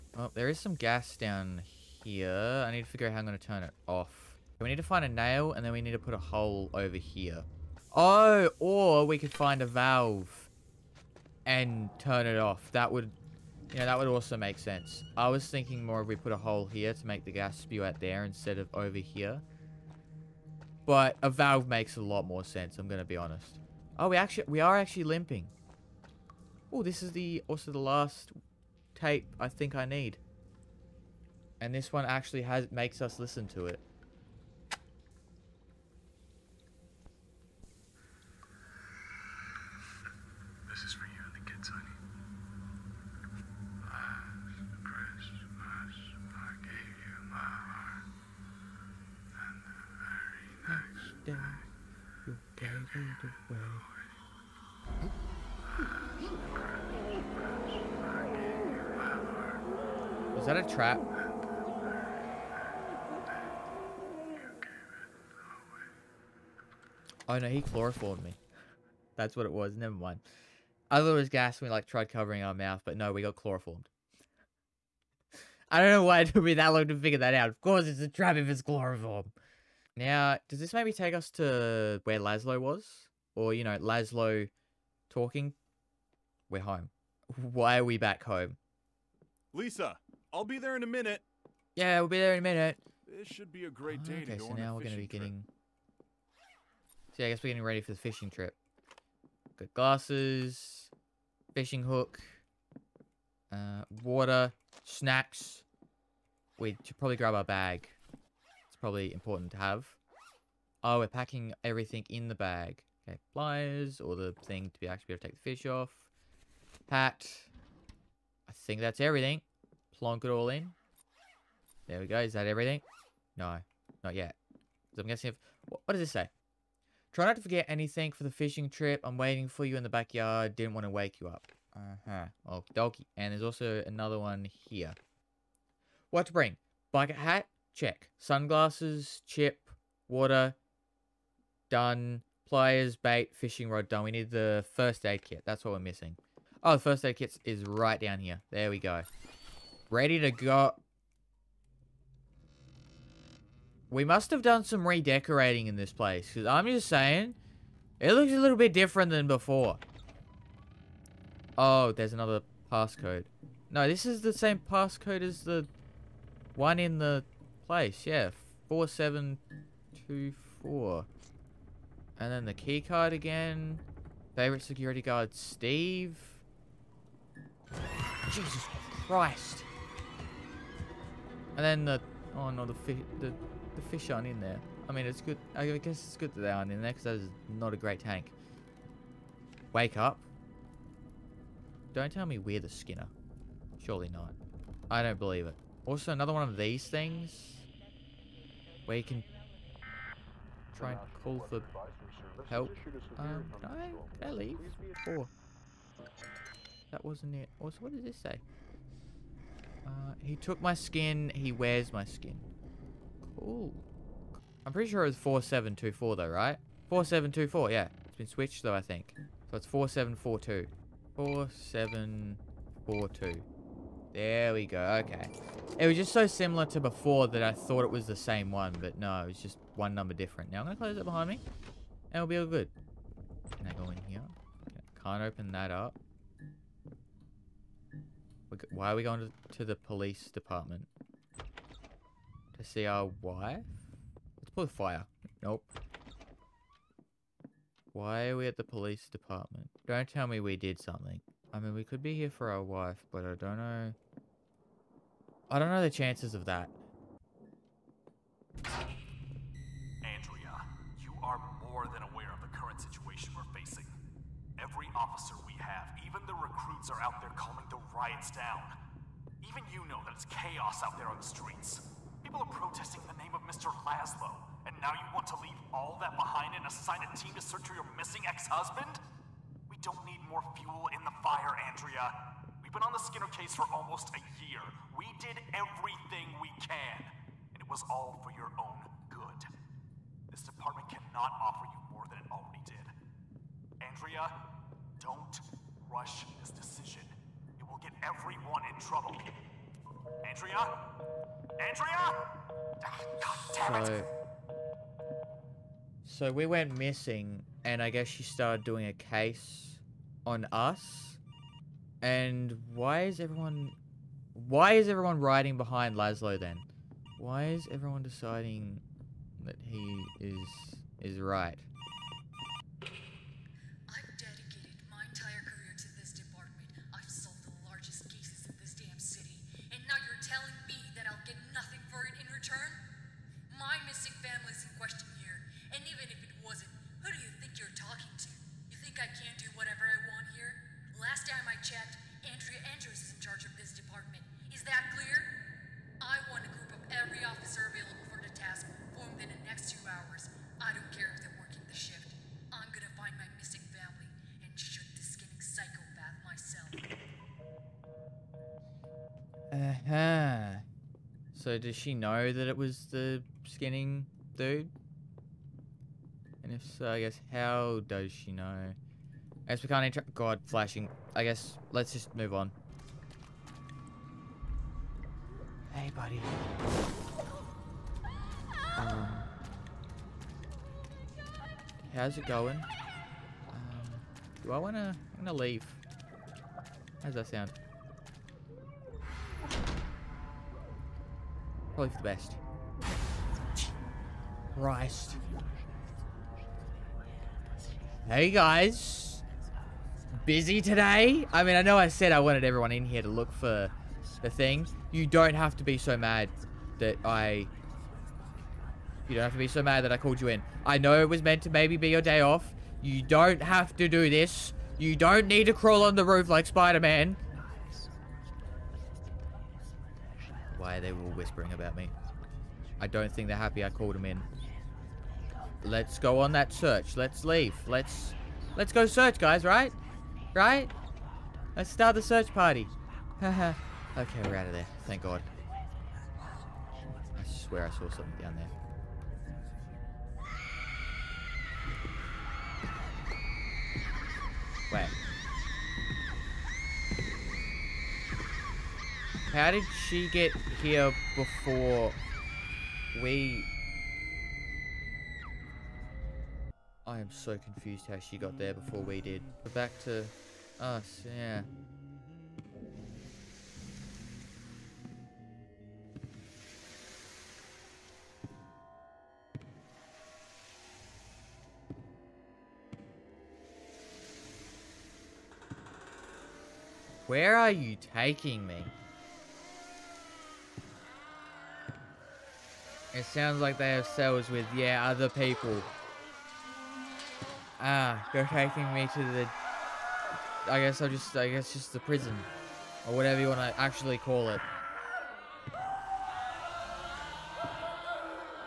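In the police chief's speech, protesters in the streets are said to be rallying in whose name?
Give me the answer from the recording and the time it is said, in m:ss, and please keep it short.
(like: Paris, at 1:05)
Mr. Laszlo, at 4:33.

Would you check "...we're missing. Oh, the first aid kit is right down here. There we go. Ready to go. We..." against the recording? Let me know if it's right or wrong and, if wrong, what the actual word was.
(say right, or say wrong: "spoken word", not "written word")
right.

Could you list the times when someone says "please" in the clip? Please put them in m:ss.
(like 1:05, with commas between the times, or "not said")
not said.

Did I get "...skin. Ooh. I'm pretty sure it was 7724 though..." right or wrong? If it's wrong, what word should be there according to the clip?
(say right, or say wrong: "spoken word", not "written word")
wrong: "4724", not "7724".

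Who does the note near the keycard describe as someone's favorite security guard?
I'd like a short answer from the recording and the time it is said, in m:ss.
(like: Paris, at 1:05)
Steve, at 2:55.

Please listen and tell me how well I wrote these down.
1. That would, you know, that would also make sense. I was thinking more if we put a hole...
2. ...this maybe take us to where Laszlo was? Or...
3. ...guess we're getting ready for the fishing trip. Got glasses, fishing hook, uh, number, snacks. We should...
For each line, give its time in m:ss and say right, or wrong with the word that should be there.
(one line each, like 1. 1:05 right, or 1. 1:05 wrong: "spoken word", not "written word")
1. 0:12 right
2. 1:20 right
3. 1:37 wrong: "water", not "number".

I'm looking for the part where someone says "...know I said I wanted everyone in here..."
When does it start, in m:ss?
6:41.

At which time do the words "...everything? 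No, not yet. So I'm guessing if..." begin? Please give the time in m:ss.
2:02.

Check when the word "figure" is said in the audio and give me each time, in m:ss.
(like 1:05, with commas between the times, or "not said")
0:02, 1:16.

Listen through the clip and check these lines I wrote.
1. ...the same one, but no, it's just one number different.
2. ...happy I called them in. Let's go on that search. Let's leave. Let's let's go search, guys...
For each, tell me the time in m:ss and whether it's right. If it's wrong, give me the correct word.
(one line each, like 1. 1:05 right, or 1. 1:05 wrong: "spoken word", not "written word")
1. 3:48 right
2. 7:03 right.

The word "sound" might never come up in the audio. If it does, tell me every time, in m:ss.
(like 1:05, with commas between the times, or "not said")
6:27, 8:03.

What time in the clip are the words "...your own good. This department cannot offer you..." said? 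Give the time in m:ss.
4:48.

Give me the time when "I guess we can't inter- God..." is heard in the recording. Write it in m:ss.
6:09.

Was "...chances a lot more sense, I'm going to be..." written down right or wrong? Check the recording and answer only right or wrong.
wrong.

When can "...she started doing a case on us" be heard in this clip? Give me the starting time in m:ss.
5:08.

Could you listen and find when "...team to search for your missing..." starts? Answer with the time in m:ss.
4:37.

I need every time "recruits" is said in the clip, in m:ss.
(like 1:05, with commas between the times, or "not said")
4:26.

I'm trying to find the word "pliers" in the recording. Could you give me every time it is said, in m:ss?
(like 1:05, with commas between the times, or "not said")
1:53, 2:22.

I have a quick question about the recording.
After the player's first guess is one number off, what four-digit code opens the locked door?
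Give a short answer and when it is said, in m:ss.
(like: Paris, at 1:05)
4742, at 3:41.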